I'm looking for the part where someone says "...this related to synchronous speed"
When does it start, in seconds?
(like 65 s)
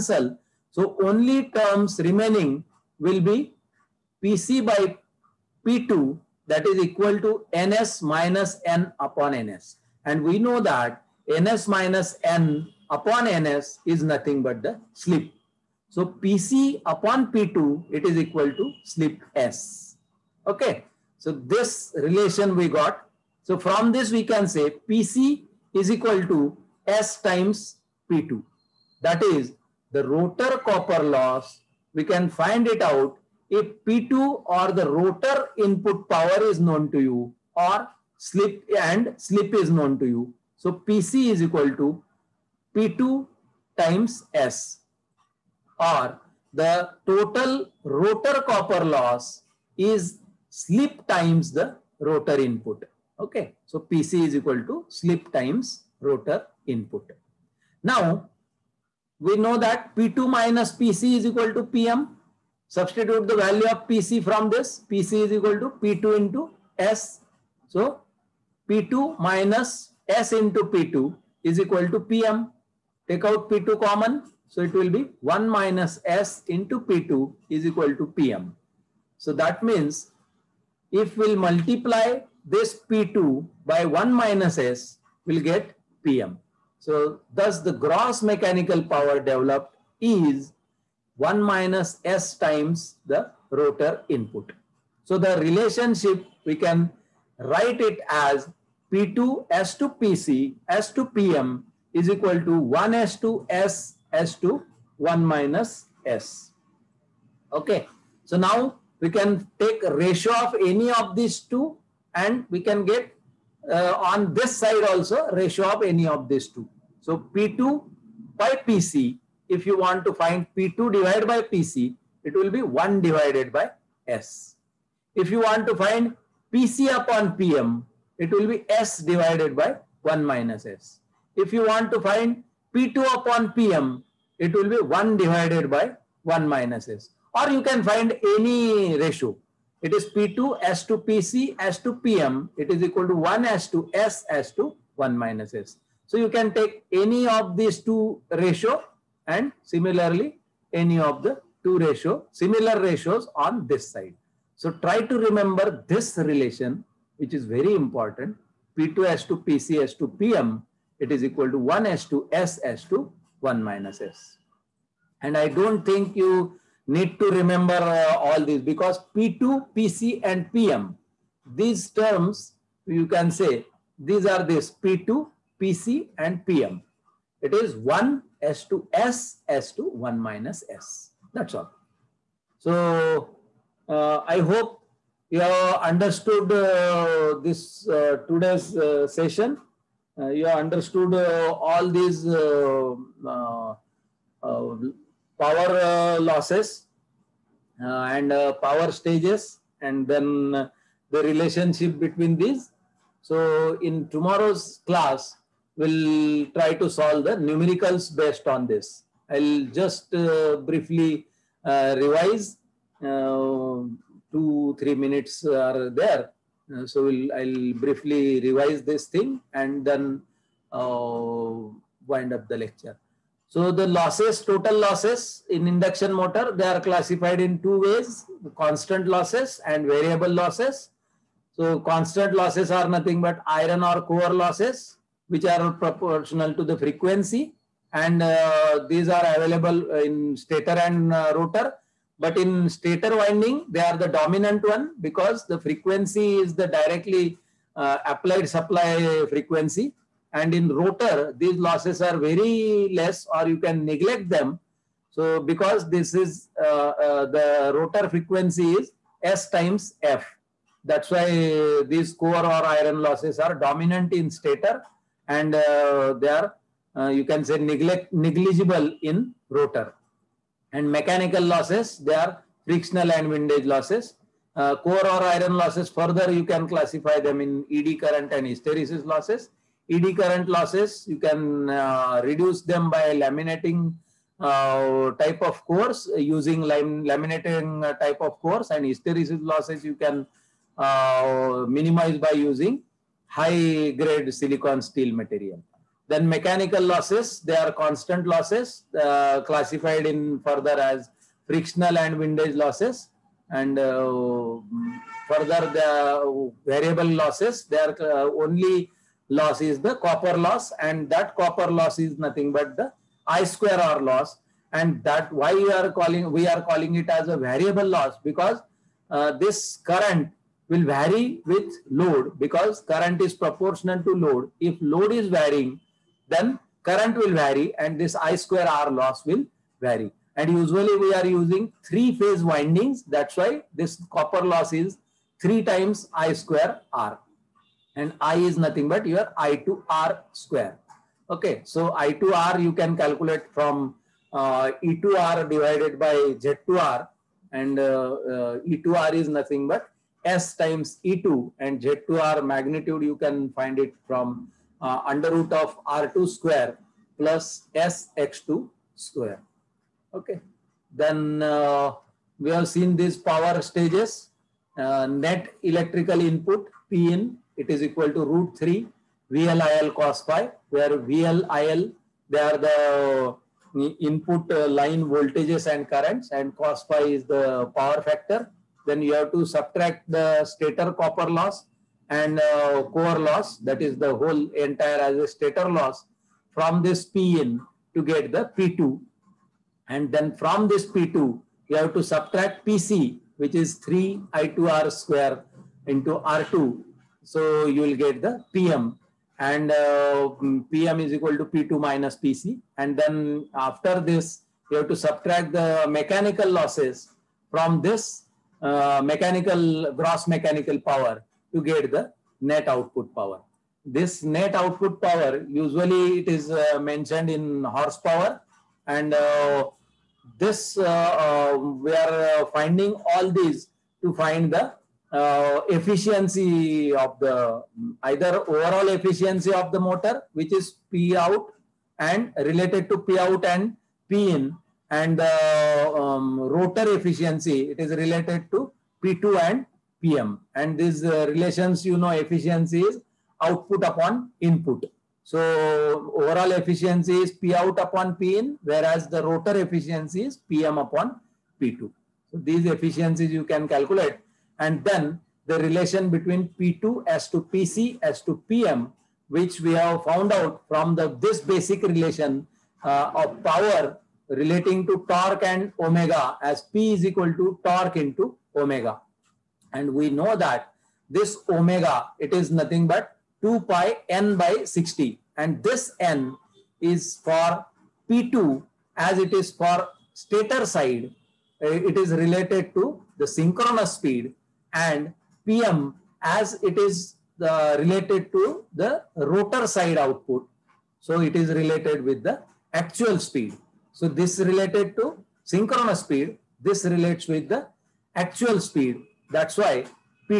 494 s.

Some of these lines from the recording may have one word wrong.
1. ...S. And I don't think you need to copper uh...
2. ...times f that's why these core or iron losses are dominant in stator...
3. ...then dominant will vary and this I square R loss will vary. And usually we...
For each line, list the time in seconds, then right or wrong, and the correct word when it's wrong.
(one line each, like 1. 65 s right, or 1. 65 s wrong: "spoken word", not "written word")
1. 163 s wrong: "remember", not "copper"
2. 259 s right
3. 326 s wrong: "current", not "dominant".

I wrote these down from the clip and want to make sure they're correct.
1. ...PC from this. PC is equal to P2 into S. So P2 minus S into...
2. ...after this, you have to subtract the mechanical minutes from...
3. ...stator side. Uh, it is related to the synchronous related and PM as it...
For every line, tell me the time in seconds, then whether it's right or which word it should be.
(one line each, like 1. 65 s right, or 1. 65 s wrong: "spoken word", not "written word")
1. 63 s right
2. 403 s wrong: "losses", not "minutes"
3. 480 s wrong: "speed", not "related".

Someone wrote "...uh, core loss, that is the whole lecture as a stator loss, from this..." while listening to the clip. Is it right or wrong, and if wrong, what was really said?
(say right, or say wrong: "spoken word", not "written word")
wrong: "entire", not "lecture".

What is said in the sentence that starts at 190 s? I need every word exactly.
Uh, you have understood uh, all these power losses and power stages and then the relationship between these.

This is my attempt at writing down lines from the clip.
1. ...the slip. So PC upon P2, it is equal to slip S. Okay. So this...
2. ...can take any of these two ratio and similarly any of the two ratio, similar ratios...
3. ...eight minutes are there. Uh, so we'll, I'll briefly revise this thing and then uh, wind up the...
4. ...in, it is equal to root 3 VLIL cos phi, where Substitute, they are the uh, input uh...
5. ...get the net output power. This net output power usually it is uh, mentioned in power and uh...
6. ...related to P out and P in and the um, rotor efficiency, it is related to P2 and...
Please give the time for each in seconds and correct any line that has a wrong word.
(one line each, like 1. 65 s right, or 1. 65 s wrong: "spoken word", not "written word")
1. 14 s right
2. 146 s right
3. 214 s wrong: "three", not "eight"
4. 367 s wrong: "VLIL", not "Substitute"
5. 411 s wrong: "horsepower", not "power"
6. 432 s right.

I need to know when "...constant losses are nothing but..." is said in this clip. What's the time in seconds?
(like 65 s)
231 s.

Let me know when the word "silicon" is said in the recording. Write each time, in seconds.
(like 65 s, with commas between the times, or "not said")
294 s.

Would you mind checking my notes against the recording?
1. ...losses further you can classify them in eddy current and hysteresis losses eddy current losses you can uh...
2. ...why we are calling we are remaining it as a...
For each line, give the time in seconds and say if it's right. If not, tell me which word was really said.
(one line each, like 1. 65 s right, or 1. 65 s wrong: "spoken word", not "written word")
1. 275 s right
2. 315 s wrong: "calling", not "remaining".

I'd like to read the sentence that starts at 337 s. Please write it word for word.
And I is nothing but your I2R square.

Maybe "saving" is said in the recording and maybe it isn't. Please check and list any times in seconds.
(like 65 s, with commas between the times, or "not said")
not said.